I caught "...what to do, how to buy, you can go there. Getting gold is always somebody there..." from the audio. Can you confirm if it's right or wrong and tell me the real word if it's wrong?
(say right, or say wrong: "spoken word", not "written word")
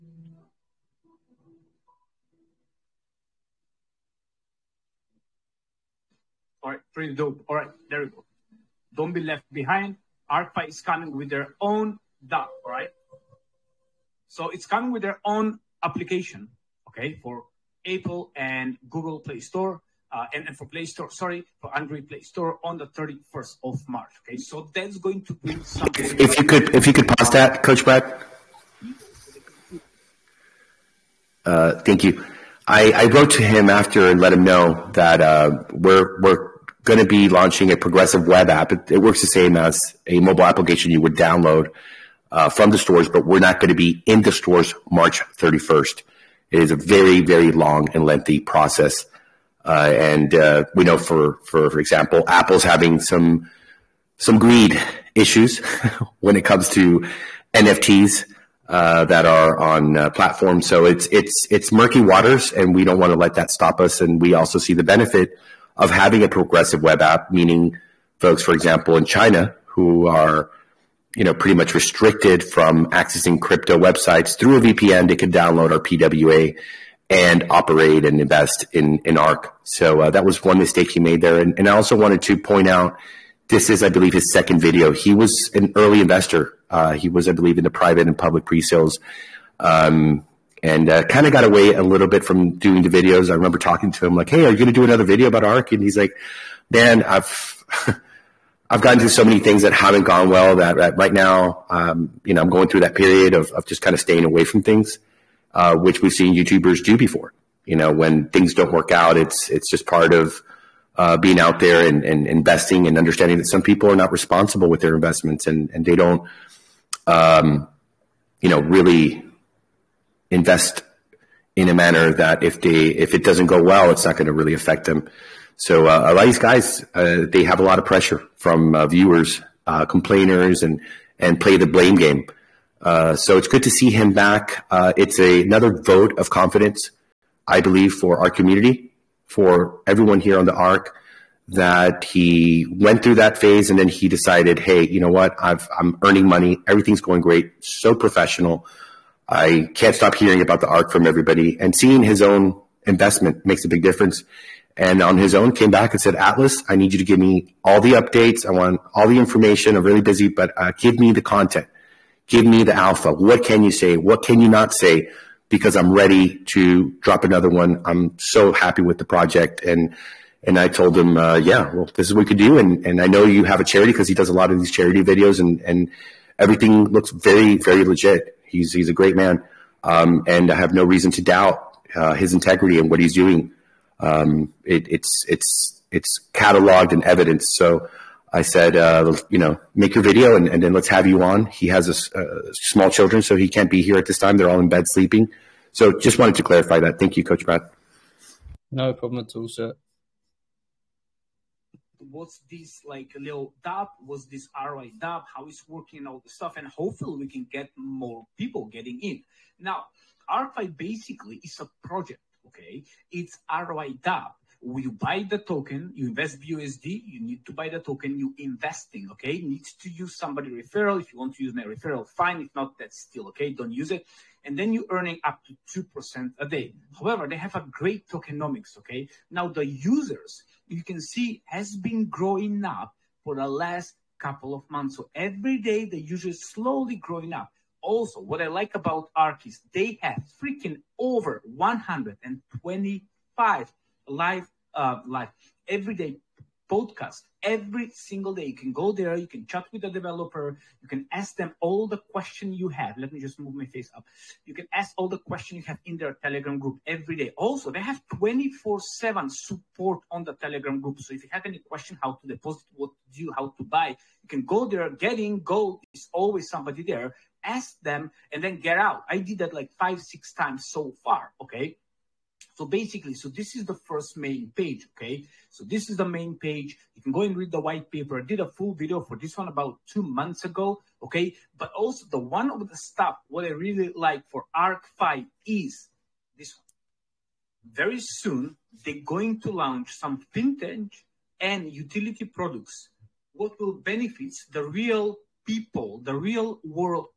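right.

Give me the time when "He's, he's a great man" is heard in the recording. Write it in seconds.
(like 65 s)
178 s.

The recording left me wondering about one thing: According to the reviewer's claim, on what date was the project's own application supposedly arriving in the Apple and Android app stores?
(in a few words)
31st of March.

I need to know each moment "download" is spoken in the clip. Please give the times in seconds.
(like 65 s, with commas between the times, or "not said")
41 s, 75 s.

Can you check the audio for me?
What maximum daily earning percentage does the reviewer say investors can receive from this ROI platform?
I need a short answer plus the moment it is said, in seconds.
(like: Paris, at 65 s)
2%, at 225 s.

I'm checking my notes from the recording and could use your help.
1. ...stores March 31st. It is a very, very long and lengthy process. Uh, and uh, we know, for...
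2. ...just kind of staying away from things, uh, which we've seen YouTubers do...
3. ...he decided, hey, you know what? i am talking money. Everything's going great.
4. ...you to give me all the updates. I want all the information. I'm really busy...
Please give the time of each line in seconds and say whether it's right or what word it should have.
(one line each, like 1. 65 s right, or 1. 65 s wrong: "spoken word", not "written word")
1. 44 s right
2. 103 s right
3. 143 s wrong: "earning", not "talking"
4. 156 s right.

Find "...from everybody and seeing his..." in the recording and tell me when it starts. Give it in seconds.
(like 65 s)
150 s.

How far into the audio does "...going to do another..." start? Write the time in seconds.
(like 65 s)
94 s.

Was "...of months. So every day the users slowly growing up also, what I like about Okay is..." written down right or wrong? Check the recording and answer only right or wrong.
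wrong.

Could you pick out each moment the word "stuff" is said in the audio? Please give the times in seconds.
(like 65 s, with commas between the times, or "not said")
206 s, 282 s.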